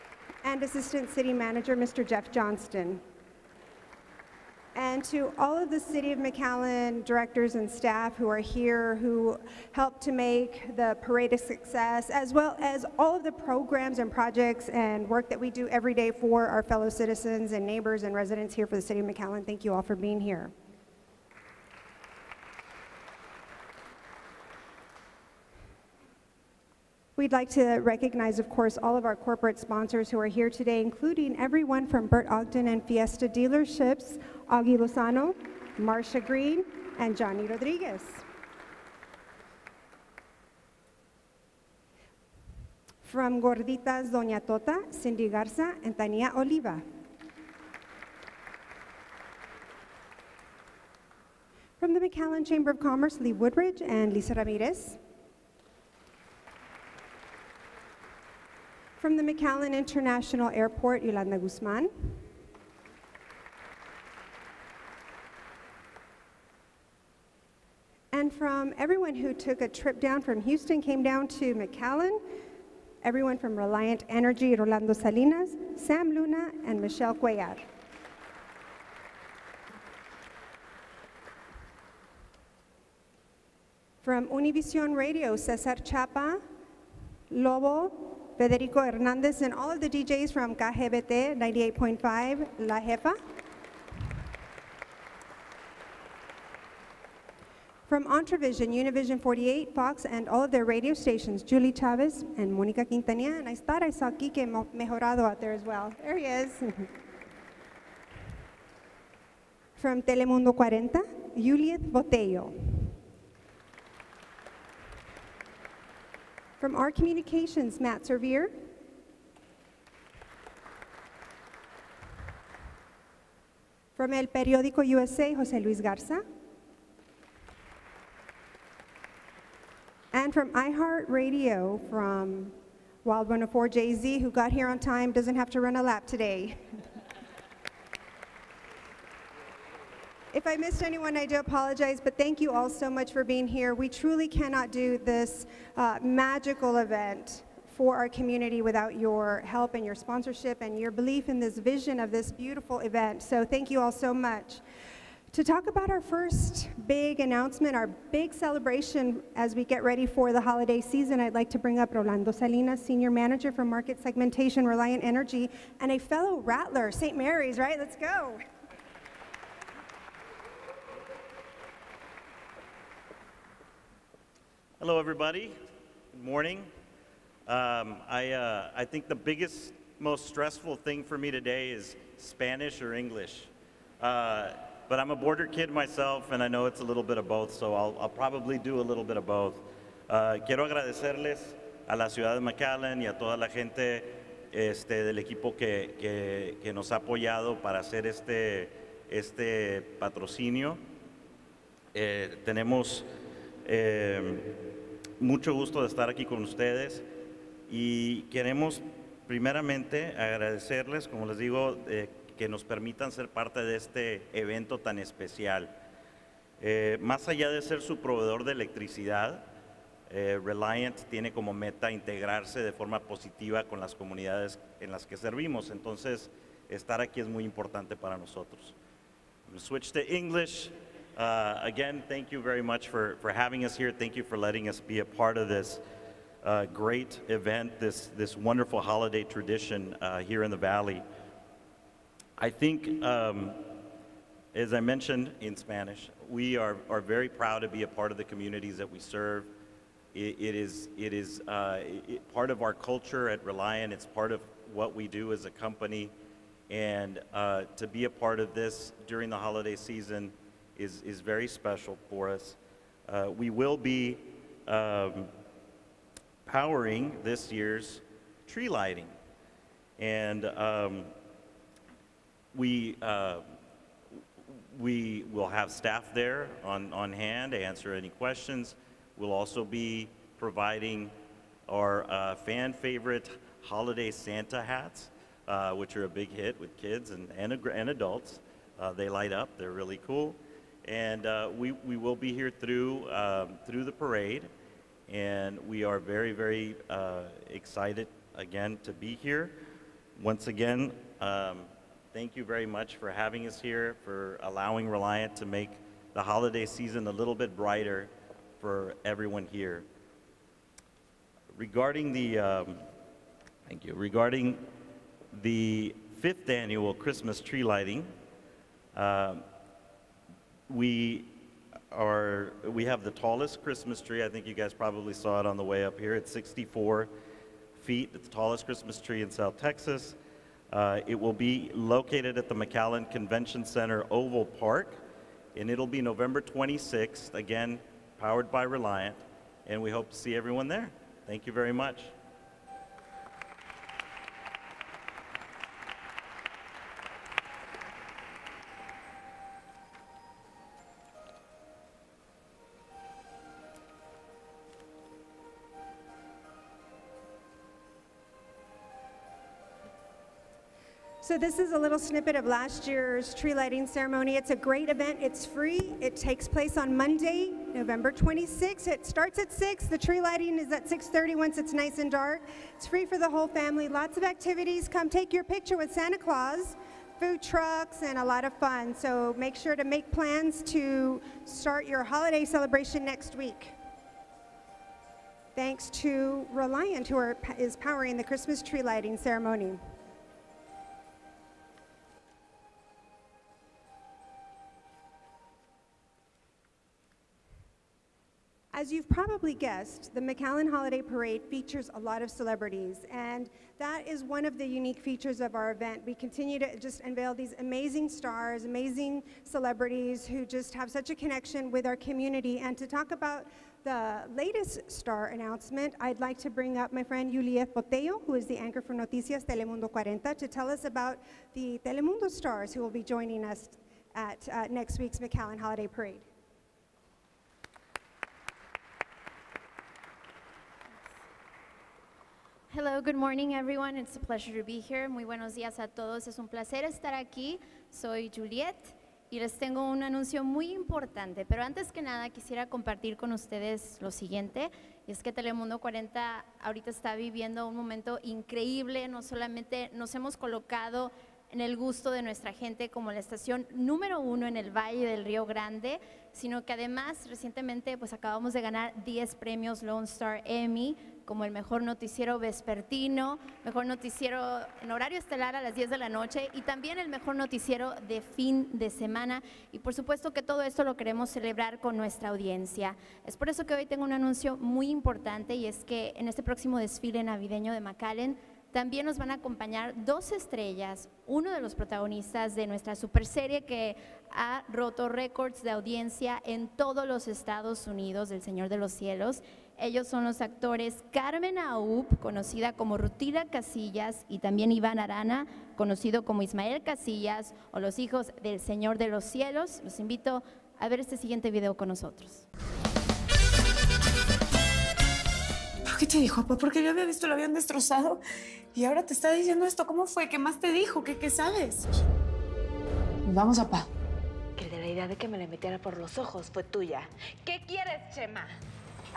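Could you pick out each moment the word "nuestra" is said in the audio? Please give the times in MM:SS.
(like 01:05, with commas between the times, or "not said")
07:32, 07:51, 08:02.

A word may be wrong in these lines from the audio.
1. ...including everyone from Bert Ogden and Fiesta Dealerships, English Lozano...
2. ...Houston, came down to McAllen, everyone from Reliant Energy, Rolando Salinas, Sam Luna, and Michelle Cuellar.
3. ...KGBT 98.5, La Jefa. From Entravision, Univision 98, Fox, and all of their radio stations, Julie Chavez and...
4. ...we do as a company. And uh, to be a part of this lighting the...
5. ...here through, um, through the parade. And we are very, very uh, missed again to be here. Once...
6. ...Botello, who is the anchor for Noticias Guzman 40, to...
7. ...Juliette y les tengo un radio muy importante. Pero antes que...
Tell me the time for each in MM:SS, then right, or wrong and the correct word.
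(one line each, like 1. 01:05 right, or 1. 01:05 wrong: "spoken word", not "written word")
1. 00:30 wrong: "Augie", not "English"
2. 01:10 right
3. 01:30 wrong: "48", not "98"
4. 04:14 wrong: "during", not "lighting"
5. 04:52 wrong: "excited", not "missed"
6. 06:57 wrong: "Telemundo", not "Guzman"
7. 07:18 wrong: "anuncio", not "radio".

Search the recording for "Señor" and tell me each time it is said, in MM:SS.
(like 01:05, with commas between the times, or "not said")
08:08, 08:18.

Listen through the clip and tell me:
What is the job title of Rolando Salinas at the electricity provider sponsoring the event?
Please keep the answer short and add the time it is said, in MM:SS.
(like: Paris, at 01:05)
Senior Manager for Market Segmentation, at 02:42.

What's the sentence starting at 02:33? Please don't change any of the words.
So thank you all so much.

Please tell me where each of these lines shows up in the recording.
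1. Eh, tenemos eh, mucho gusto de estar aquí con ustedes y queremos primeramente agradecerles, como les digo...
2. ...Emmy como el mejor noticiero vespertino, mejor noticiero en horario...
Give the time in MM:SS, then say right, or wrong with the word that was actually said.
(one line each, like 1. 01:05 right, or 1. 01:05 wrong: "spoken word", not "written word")
1. 03:21 right
2. 07:40 right.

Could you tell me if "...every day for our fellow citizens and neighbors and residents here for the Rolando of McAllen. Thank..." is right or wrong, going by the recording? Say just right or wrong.
wrong.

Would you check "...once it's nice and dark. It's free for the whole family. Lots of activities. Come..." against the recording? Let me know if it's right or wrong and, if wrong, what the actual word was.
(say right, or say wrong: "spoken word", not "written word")
right.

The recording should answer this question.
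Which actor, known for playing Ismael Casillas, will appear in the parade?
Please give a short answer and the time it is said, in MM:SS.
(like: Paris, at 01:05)
Iván Arana, at 08:14.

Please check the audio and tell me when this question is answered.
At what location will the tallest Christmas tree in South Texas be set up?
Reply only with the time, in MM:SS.
05:32.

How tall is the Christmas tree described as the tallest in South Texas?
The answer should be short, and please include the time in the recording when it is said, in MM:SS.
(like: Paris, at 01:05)
64 feet, at 05:26.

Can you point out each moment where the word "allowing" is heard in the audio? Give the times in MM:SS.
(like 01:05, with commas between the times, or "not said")
05:04.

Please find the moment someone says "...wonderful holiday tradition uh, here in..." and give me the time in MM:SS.
03:58.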